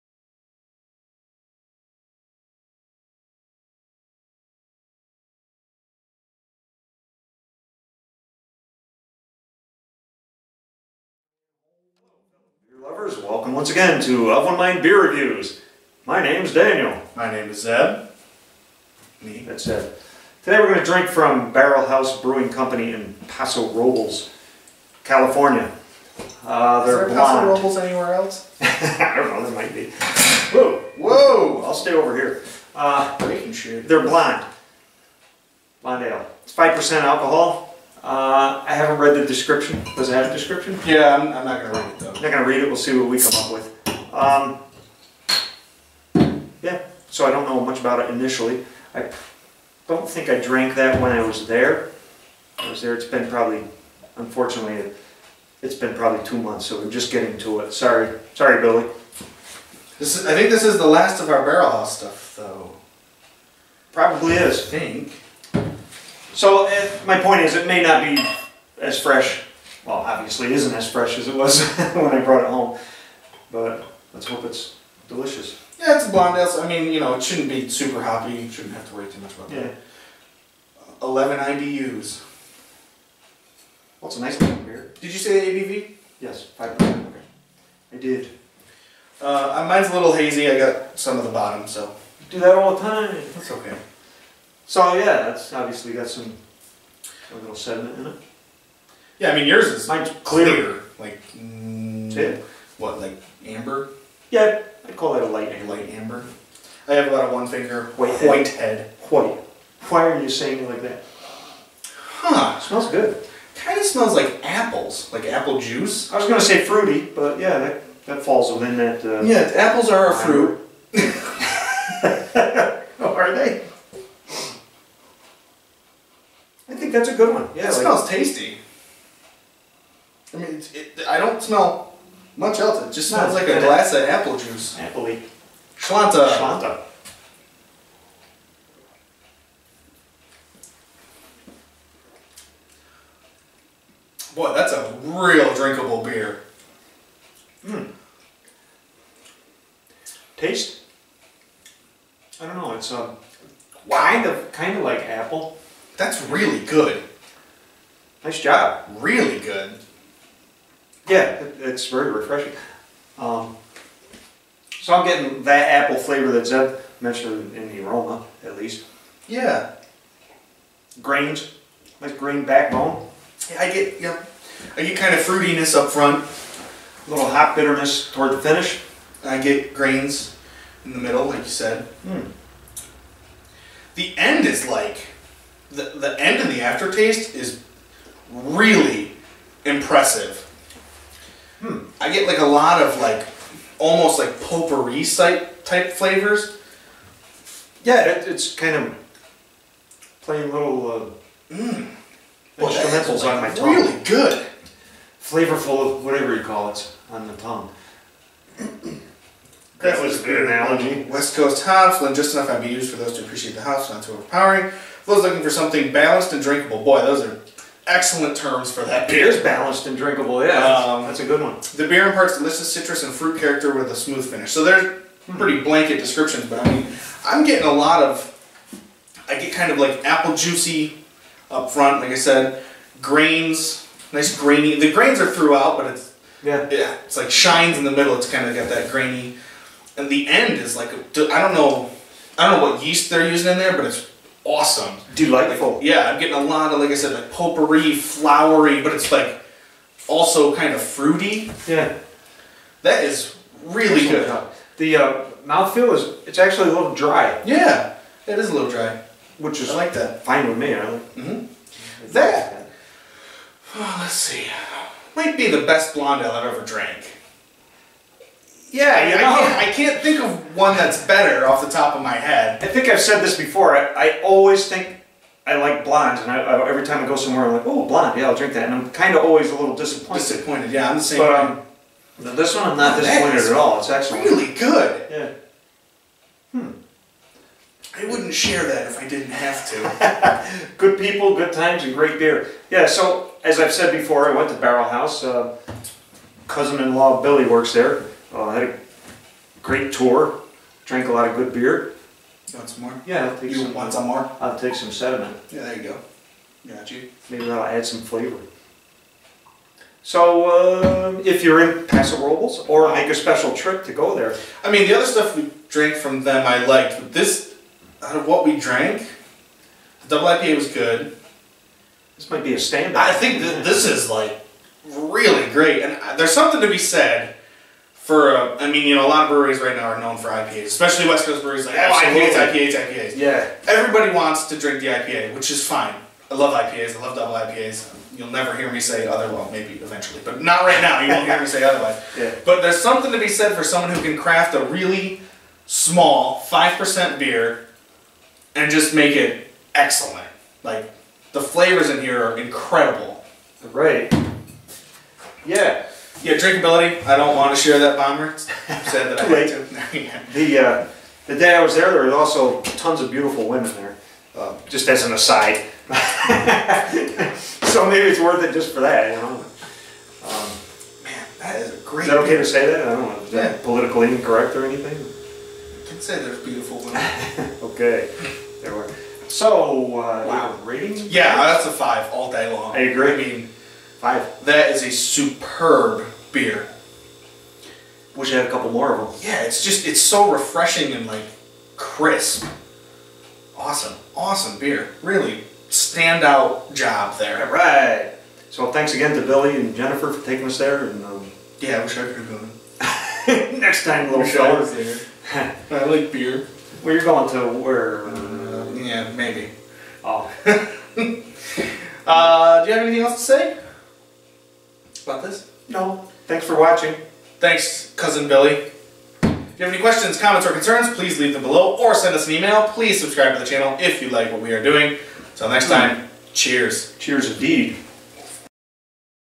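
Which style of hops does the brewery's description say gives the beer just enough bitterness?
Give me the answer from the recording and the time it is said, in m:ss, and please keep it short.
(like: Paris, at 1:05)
West Coast hops, at 3:31.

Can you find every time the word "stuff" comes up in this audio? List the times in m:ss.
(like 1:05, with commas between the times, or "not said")
1:01, 5:15.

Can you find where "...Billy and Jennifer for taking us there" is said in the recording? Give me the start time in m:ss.
6:39.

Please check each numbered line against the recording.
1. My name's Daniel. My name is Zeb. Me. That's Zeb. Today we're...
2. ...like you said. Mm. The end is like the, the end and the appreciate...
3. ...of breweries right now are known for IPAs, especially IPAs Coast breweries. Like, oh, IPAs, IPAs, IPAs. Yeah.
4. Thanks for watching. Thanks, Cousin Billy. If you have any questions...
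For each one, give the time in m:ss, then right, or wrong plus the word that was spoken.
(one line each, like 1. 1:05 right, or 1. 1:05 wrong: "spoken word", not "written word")
1. 0:16 right
2. 3:01 wrong: "aftertaste", not "appreciate"
3. 5:29 wrong: "West", not "IPAs"
4. 6:56 right.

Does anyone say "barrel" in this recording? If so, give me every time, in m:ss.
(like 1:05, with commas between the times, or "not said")
0:21, 1:01, 4:54.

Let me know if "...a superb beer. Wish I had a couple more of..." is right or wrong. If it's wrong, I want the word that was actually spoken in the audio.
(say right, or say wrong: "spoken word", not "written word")
right.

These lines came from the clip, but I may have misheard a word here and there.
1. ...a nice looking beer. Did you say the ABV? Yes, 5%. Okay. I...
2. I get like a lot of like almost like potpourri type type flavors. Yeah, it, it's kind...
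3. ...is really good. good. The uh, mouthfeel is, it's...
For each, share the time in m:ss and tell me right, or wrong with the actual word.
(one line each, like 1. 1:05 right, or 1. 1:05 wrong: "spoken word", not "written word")
1. 1:24 right
2. 3:11 right
3. 4:13 right.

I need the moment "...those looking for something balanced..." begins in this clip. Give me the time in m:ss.
3:35.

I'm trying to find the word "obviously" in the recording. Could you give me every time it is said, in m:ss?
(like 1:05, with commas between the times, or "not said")
1:09, 1:35.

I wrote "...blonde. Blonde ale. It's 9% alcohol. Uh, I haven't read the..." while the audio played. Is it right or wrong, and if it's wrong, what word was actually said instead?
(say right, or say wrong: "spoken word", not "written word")
wrong: "5", not "9".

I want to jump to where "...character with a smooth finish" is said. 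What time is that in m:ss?
3:43.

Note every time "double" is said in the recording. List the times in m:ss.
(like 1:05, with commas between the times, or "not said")
5:20, 5:37.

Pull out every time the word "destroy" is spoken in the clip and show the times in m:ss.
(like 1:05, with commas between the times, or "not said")
not said.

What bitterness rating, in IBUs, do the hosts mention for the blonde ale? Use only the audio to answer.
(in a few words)
11.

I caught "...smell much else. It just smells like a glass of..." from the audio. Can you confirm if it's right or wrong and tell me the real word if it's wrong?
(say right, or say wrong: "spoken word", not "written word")
right.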